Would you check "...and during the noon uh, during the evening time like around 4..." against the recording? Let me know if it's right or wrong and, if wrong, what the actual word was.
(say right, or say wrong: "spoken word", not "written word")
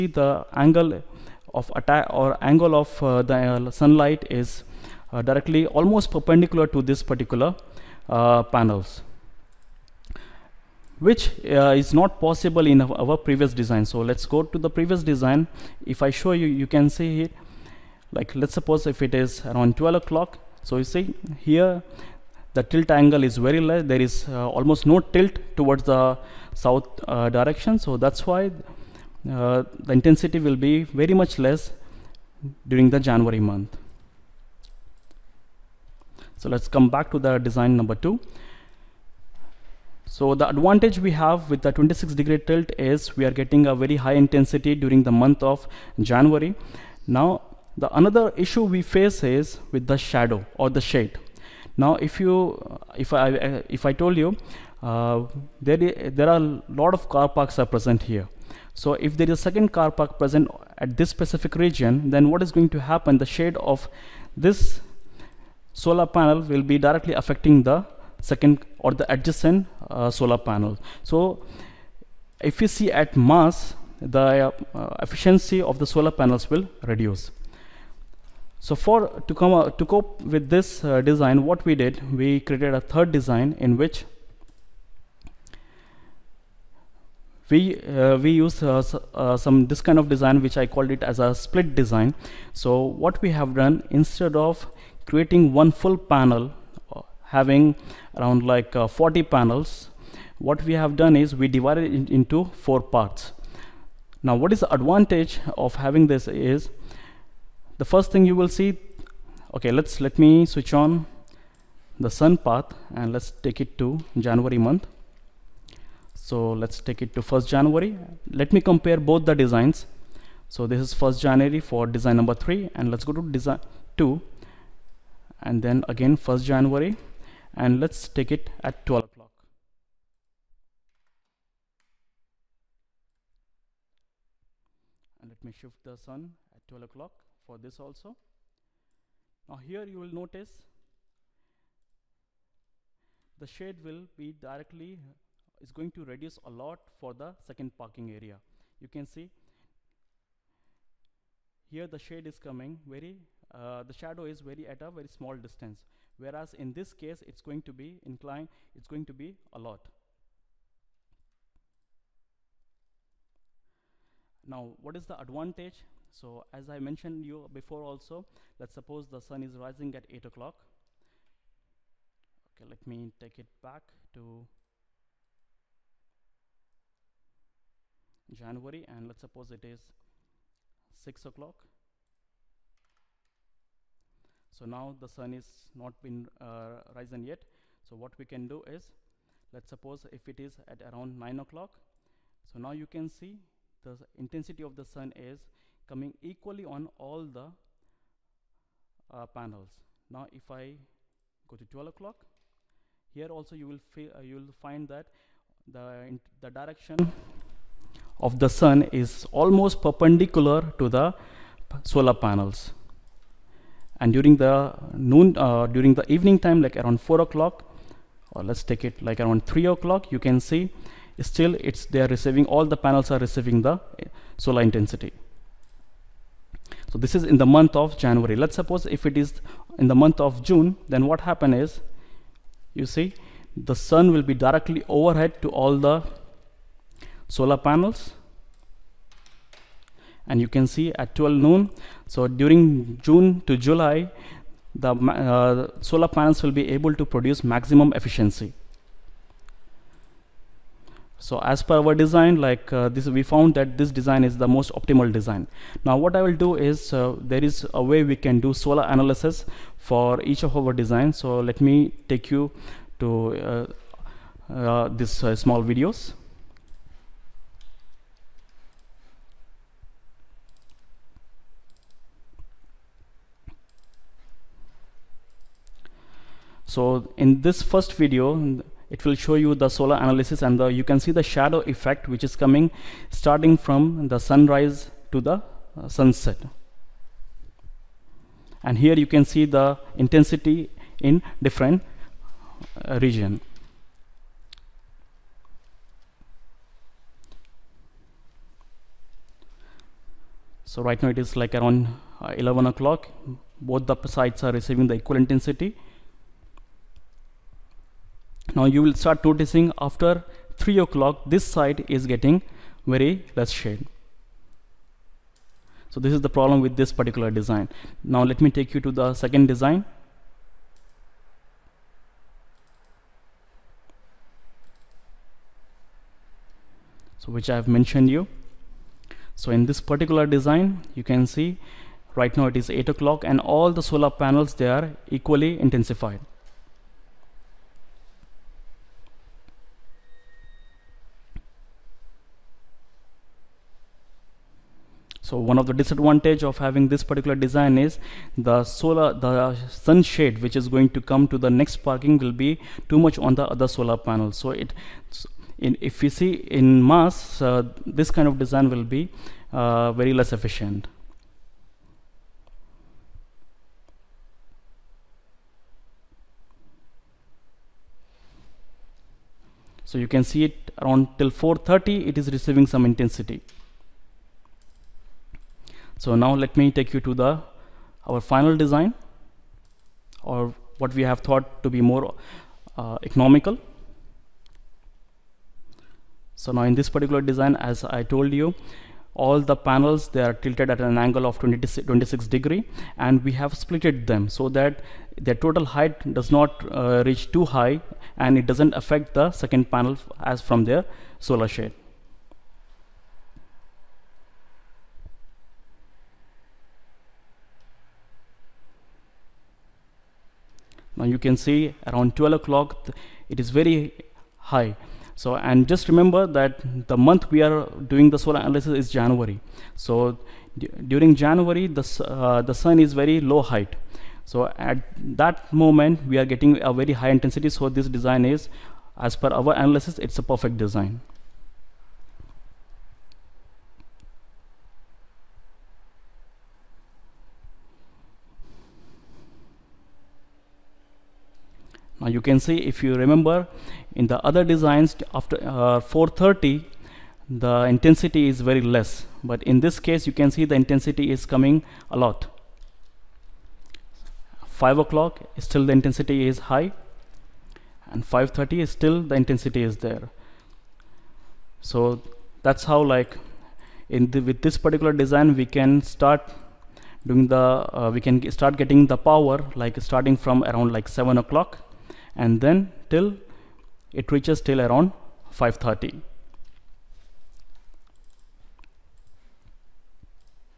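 right.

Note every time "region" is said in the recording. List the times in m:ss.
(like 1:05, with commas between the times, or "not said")
1:01, 4:53.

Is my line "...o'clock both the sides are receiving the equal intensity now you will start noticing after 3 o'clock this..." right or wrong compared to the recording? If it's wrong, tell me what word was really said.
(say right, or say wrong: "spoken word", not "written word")
right.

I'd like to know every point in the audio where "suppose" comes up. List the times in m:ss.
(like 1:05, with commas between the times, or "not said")
0:18, 2:48, 2:59, 3:09, 3:48.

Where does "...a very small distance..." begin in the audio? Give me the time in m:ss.
2:34.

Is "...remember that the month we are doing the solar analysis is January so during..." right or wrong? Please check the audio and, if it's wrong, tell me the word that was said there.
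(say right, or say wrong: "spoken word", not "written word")
right.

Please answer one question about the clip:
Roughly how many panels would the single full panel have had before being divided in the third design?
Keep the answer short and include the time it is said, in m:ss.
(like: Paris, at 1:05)
40, at 1:38.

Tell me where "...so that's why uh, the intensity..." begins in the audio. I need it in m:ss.
0:27.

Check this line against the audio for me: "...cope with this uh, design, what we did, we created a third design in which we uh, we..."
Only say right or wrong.
right.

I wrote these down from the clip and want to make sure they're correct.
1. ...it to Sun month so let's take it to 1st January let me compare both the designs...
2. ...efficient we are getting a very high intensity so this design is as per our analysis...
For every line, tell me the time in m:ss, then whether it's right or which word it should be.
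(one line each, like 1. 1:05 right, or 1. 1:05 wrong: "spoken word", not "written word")
1. 1:53 wrong: "January", not "Sun"
2. 7:05 wrong: "moment", not "efficient".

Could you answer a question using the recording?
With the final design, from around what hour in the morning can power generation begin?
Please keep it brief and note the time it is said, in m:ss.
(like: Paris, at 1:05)
7 o'clock, at 7:51.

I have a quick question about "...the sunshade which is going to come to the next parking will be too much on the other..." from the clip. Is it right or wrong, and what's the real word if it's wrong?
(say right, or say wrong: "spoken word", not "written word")
right.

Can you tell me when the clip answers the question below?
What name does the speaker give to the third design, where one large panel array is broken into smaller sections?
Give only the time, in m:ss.
1:31.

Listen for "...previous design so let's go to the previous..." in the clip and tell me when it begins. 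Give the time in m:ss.
0:13.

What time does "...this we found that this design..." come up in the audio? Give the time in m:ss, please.
4:12.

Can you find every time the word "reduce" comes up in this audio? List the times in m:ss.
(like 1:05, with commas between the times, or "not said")
1:16, 2:26.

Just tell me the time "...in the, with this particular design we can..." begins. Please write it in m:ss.
7:43.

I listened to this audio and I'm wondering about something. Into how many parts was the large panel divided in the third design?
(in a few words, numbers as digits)
4.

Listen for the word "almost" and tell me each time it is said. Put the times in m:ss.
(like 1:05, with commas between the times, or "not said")
0:05, 0:24, 3:29.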